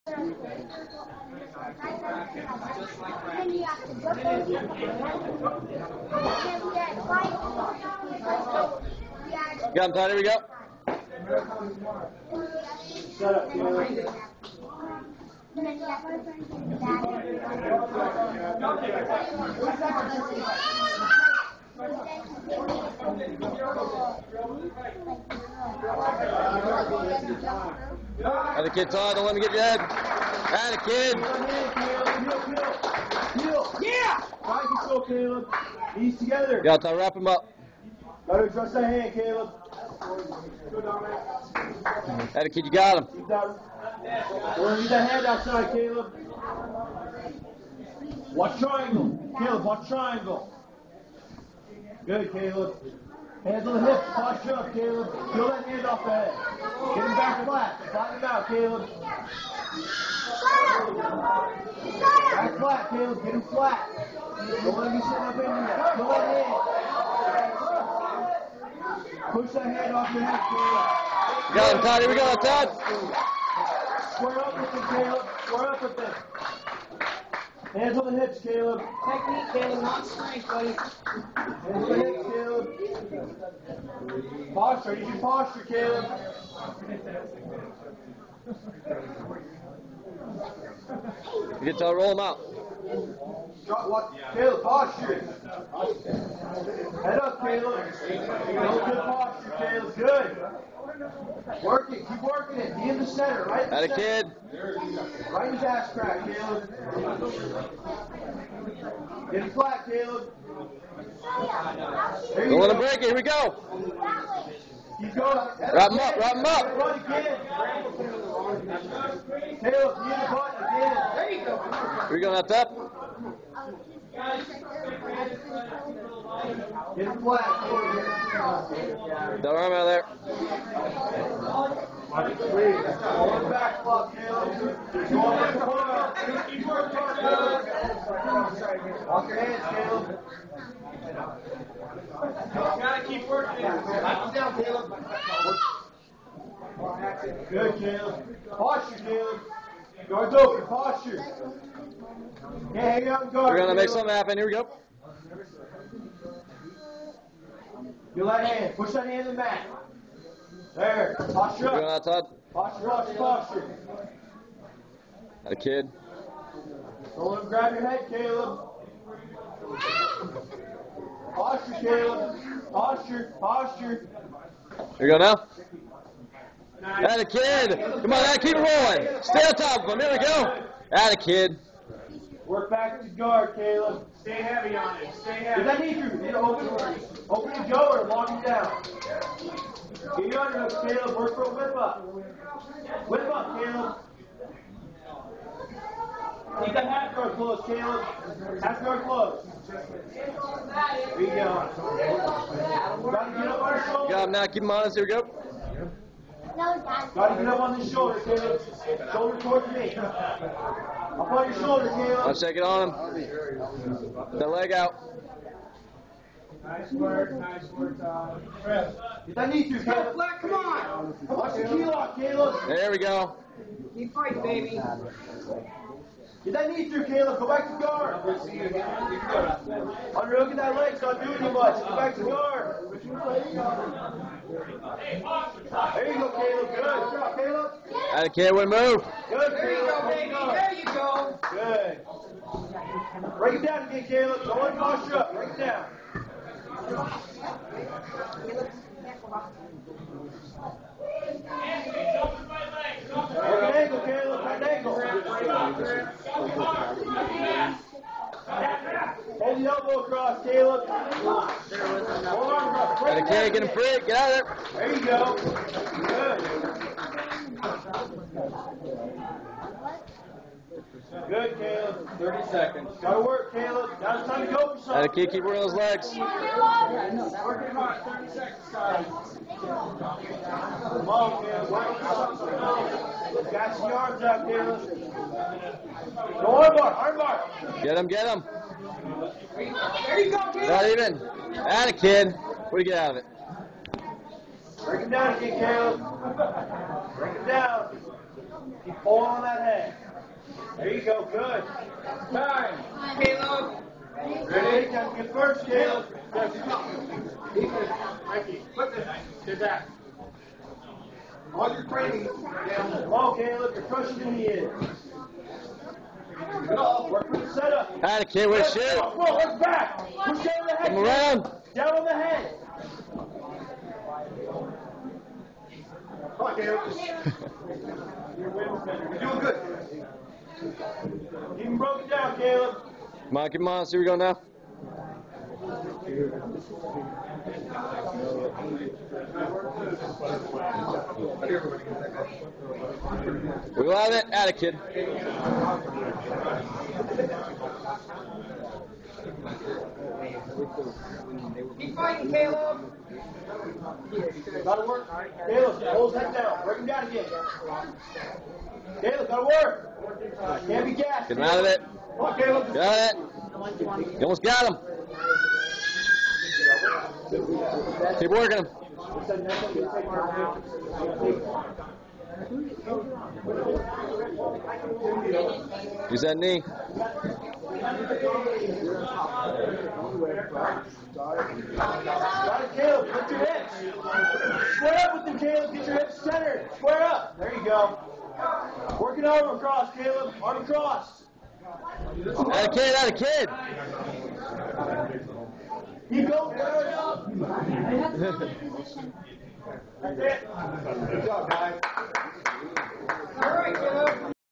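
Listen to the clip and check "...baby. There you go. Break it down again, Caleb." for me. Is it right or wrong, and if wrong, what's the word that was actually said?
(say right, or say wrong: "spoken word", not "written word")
right.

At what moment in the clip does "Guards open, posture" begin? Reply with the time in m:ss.
2:30.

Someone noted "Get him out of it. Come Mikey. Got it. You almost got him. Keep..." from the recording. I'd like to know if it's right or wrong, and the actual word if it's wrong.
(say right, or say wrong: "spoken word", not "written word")
wrong: "Caleb", not "Mikey".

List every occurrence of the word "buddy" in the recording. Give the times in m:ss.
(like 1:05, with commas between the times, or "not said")
1:20.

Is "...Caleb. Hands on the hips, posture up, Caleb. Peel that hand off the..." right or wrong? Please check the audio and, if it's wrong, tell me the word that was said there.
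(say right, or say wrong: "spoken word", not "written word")
right.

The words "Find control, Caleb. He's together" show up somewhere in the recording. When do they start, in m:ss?
0:34.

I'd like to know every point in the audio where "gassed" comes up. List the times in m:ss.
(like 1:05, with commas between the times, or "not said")
6:00.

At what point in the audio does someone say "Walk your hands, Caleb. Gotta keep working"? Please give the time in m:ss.
2:19.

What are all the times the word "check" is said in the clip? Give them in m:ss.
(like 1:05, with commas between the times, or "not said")
3:32.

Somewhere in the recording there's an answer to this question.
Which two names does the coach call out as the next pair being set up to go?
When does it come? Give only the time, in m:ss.
5:33.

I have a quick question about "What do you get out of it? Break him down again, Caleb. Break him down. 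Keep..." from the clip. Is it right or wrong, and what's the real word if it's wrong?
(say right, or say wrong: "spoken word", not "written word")
right.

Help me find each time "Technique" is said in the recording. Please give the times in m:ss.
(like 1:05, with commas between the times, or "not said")
1:19.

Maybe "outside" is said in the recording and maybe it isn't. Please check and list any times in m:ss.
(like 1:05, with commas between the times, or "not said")
0:45, 2:41.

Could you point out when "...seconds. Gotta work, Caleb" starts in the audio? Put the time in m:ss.
4:32.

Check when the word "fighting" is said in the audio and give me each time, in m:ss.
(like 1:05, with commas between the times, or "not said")
3:44, 5:51.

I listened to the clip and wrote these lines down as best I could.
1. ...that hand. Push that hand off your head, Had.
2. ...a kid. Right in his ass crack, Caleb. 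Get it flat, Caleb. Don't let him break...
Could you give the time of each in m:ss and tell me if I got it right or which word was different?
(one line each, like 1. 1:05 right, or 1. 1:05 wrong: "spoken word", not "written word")
1. 1:06 wrong: "Caleb", not "Had"
2. 1:43 right.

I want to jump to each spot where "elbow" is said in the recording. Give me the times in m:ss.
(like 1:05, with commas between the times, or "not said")
4:19.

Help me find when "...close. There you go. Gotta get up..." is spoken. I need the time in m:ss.
3:19.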